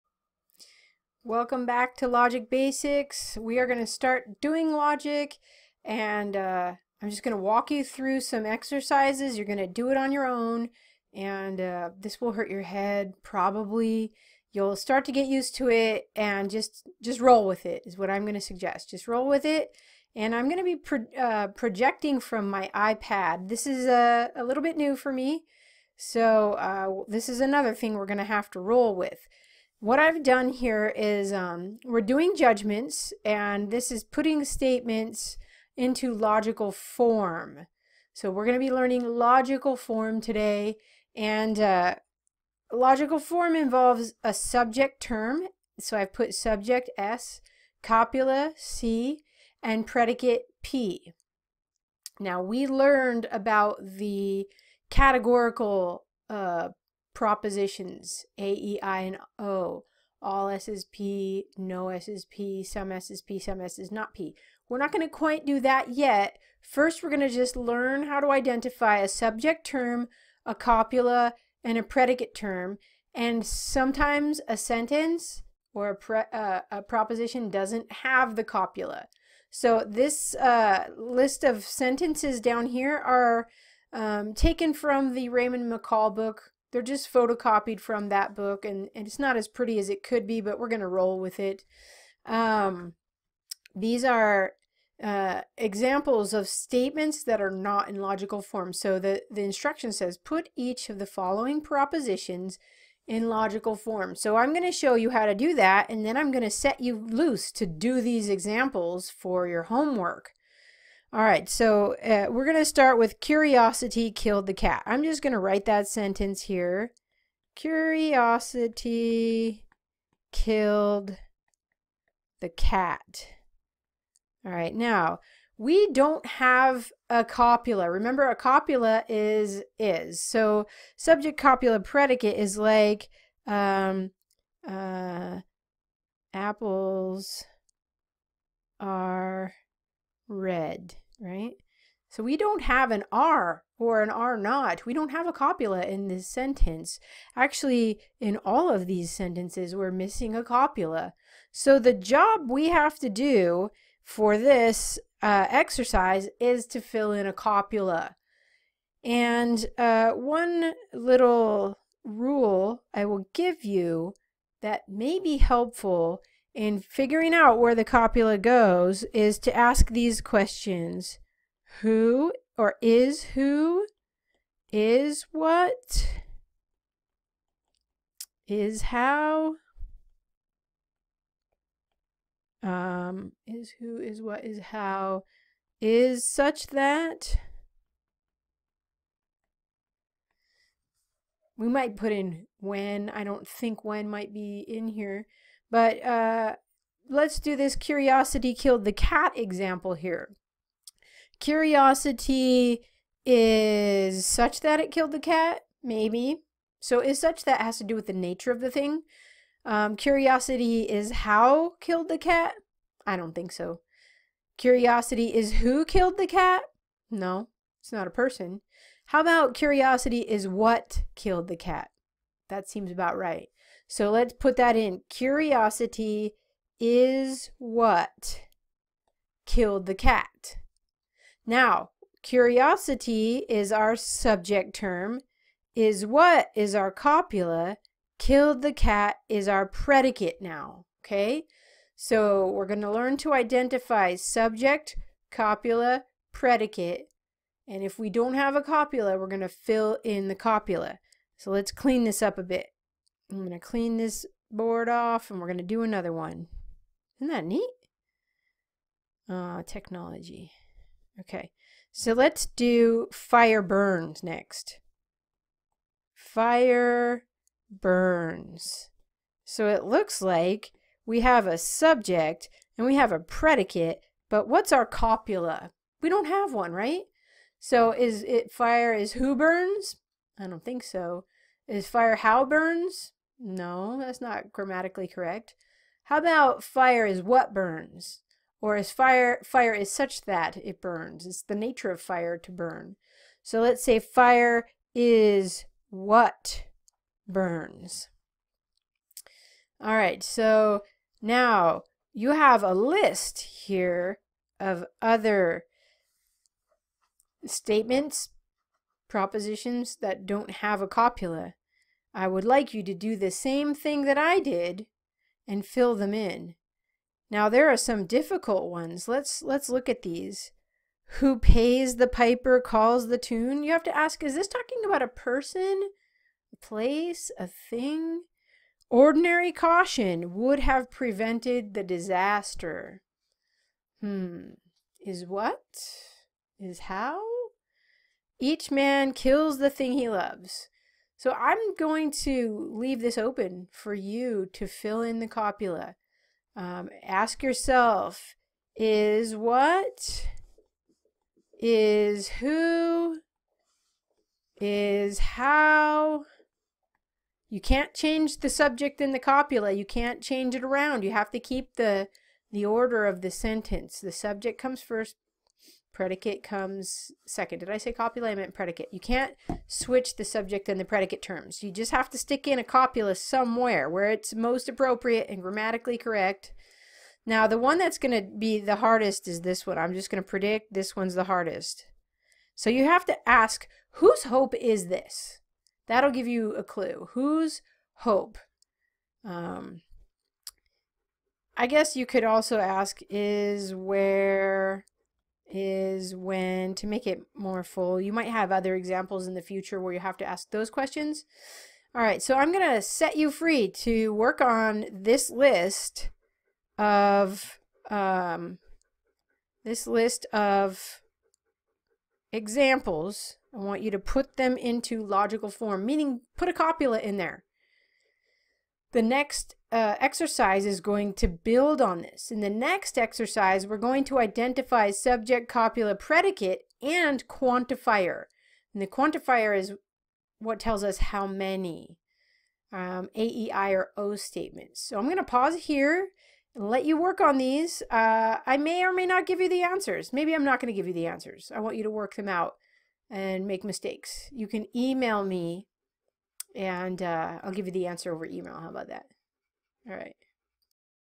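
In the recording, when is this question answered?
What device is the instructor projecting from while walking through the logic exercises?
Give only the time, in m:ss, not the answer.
0:22.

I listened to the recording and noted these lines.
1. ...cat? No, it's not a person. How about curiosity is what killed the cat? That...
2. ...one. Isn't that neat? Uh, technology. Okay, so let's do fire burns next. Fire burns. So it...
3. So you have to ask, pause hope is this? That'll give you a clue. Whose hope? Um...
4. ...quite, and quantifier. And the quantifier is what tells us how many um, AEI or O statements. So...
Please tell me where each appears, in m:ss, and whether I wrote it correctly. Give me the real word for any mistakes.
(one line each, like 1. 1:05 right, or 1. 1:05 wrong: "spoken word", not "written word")
1. 3:36 right
2. 4:16 right
3. 6:22 wrong: "whose", not "pause"
4. 7:05 wrong: "predicate", not "quite".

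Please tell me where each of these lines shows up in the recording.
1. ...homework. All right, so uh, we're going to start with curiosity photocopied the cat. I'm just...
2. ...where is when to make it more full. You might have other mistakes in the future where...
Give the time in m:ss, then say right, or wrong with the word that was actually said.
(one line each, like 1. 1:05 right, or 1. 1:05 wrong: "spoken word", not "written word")
1. 1:49 wrong: "killed", not "photocopied"
2. 6:33 wrong: "examples", not "mistakes".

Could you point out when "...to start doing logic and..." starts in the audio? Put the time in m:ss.
0:03.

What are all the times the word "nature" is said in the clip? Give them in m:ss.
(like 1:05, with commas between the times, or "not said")
3:28, 4:51.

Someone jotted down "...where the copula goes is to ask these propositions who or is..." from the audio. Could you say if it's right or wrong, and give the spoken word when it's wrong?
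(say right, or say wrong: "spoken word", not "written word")
wrong: "questions", not "propositions".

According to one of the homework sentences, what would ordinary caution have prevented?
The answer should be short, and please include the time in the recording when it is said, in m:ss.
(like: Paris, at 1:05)
the disaster, at 5:31.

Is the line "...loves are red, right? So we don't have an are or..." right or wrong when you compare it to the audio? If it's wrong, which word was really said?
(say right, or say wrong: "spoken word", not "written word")
wrong: "apples", not "loves".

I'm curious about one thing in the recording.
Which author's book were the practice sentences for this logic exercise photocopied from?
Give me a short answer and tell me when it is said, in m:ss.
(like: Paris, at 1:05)
Raymond McCall, at 1:25.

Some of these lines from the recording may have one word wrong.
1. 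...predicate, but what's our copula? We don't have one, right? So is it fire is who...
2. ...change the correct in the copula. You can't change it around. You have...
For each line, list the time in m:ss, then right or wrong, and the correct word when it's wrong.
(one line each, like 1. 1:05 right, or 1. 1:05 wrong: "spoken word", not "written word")
1. 4:33 right
2. 5:57 wrong: "subject", not "correct".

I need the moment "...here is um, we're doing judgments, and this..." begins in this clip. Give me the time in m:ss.
0:30.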